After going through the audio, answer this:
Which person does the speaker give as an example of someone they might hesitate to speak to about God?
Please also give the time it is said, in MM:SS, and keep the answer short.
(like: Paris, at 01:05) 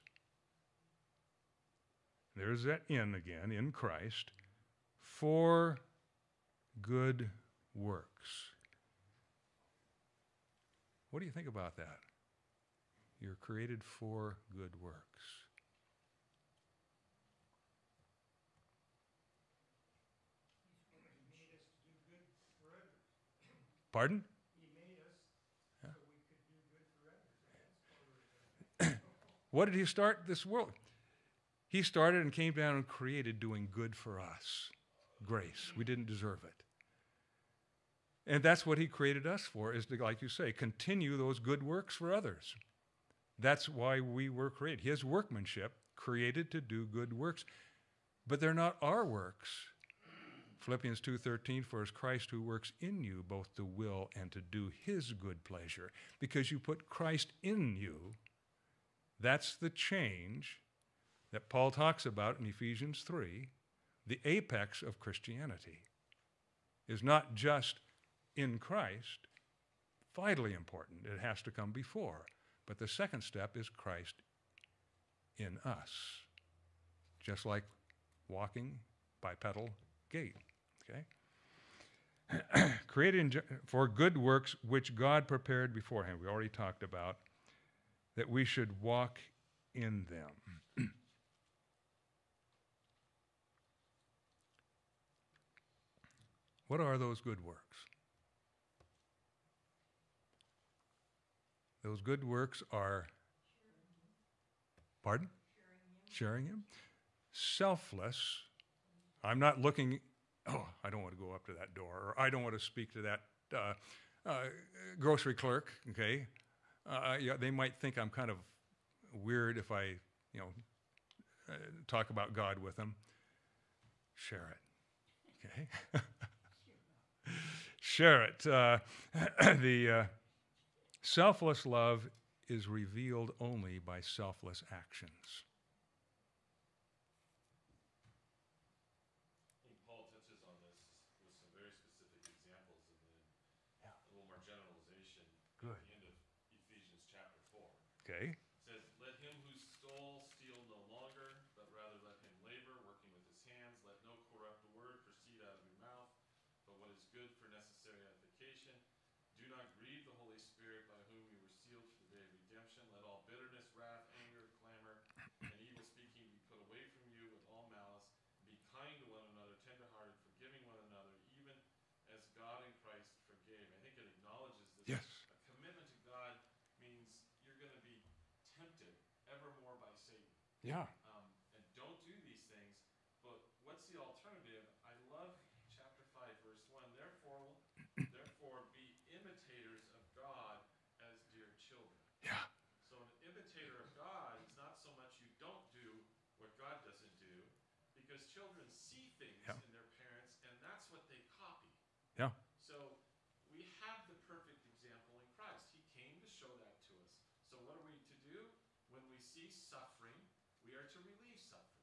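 grocery clerk, at 01:54.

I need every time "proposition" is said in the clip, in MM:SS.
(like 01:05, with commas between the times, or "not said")
not said.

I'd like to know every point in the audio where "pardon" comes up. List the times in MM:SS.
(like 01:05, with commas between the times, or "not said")
00:23, 01:45.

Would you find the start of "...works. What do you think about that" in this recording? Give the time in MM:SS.
00:07.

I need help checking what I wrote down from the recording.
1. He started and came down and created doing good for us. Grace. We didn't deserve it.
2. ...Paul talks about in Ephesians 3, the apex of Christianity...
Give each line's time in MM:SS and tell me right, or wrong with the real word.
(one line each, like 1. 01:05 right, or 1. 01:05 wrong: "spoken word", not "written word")
1. 00:31 right
2. 01:01 right.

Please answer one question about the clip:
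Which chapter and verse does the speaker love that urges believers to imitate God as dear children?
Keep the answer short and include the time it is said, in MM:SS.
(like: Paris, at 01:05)
Chapter 5, verse 1, at 03:05.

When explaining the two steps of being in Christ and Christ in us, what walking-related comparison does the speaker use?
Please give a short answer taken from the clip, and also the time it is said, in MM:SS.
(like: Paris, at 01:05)
bipedal gait, at 01:19.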